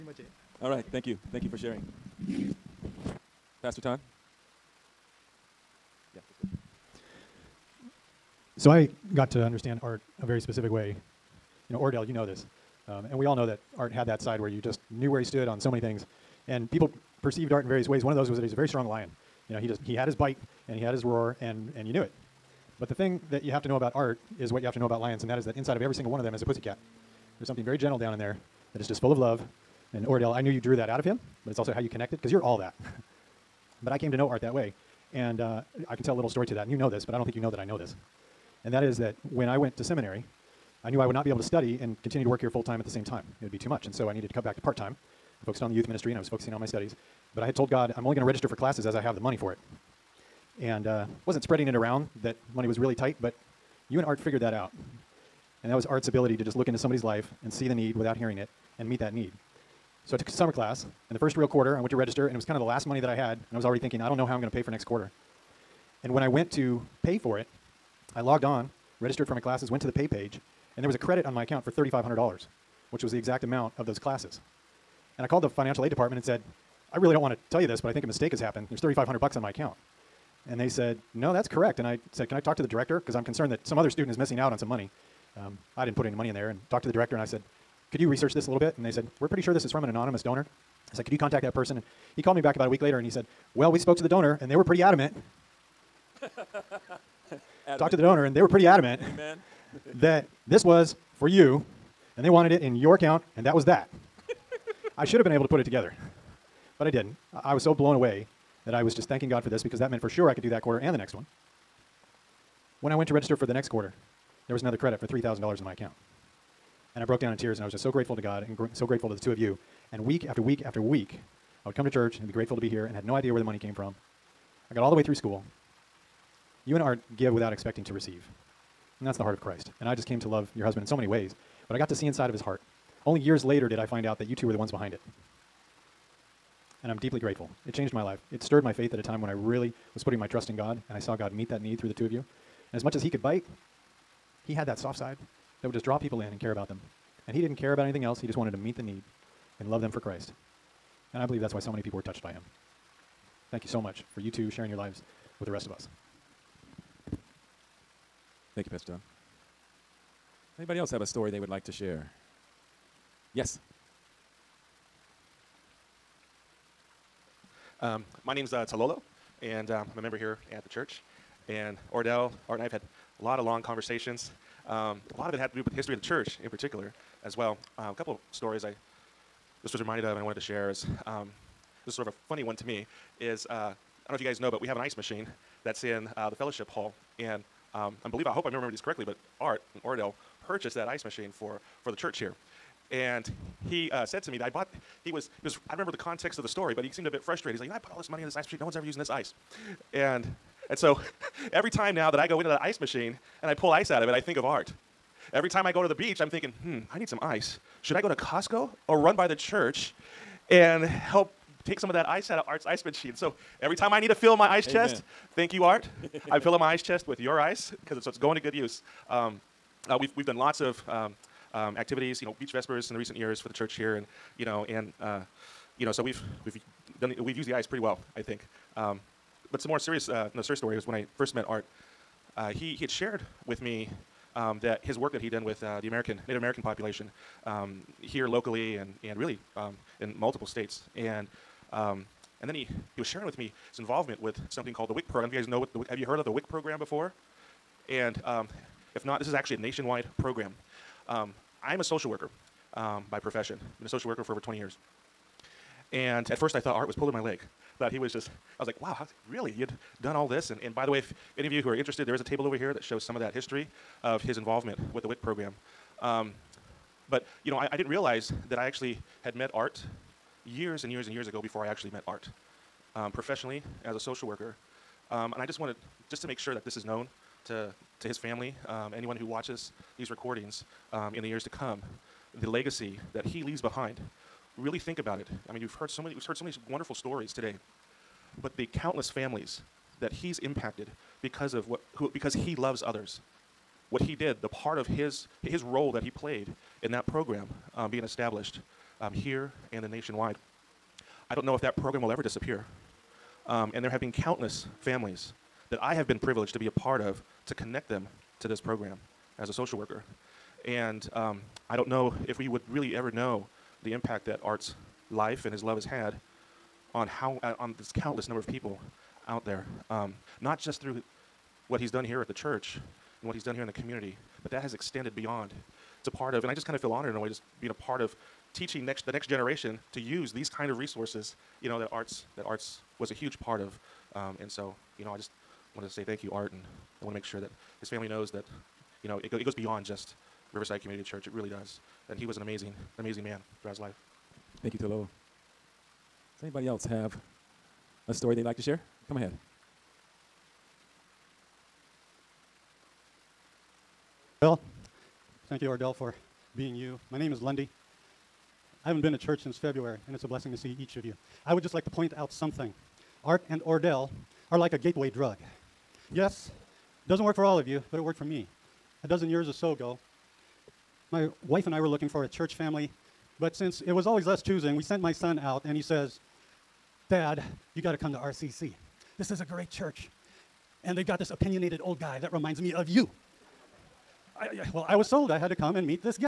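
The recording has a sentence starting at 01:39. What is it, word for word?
Amen that this was for you, and they wanted it in your account, and that was that.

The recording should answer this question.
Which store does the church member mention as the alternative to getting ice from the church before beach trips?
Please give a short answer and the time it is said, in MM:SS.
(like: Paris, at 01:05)
Costco, at 03:28.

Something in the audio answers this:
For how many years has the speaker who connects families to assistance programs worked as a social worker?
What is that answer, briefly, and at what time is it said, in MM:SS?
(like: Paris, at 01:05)
over 20 years, at 04:14.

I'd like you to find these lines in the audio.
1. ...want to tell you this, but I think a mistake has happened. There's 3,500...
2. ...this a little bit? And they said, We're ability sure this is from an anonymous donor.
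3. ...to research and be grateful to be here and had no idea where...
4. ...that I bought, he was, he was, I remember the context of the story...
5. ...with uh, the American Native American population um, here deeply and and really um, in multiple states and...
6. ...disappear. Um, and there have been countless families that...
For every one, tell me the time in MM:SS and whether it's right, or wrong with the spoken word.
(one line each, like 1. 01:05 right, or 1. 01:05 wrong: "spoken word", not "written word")
1. 01:17 right
2. 01:28 wrong: "pretty", not "ability"
3. 02:01 wrong: "church", not "research"
4. 03:14 right
5. 03:55 wrong: "locally", not "deeply"
6. 05:02 right.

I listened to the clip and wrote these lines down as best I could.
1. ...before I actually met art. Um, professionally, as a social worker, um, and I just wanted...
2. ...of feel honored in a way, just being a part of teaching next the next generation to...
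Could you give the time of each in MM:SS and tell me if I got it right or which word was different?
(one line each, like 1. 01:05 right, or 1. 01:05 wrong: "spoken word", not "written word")
1. 04:31 right
2. 05:26 right.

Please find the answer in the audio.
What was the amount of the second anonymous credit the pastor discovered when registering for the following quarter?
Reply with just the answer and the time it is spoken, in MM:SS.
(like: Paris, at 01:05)
$3,000, at 01:55.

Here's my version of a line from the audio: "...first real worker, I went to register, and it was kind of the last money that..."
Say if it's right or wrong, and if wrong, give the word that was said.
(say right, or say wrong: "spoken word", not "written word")
wrong: "quarter", not "worker".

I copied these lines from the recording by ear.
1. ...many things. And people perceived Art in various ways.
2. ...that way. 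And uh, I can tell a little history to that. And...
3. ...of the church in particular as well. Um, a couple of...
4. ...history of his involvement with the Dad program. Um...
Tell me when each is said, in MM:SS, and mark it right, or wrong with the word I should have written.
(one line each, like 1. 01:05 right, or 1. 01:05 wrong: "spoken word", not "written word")
1. 00:15 right
2. 00:34 wrong: "story", not "history"
3. 02:55 right
4. 04:23 wrong: "WIC", not "Dad".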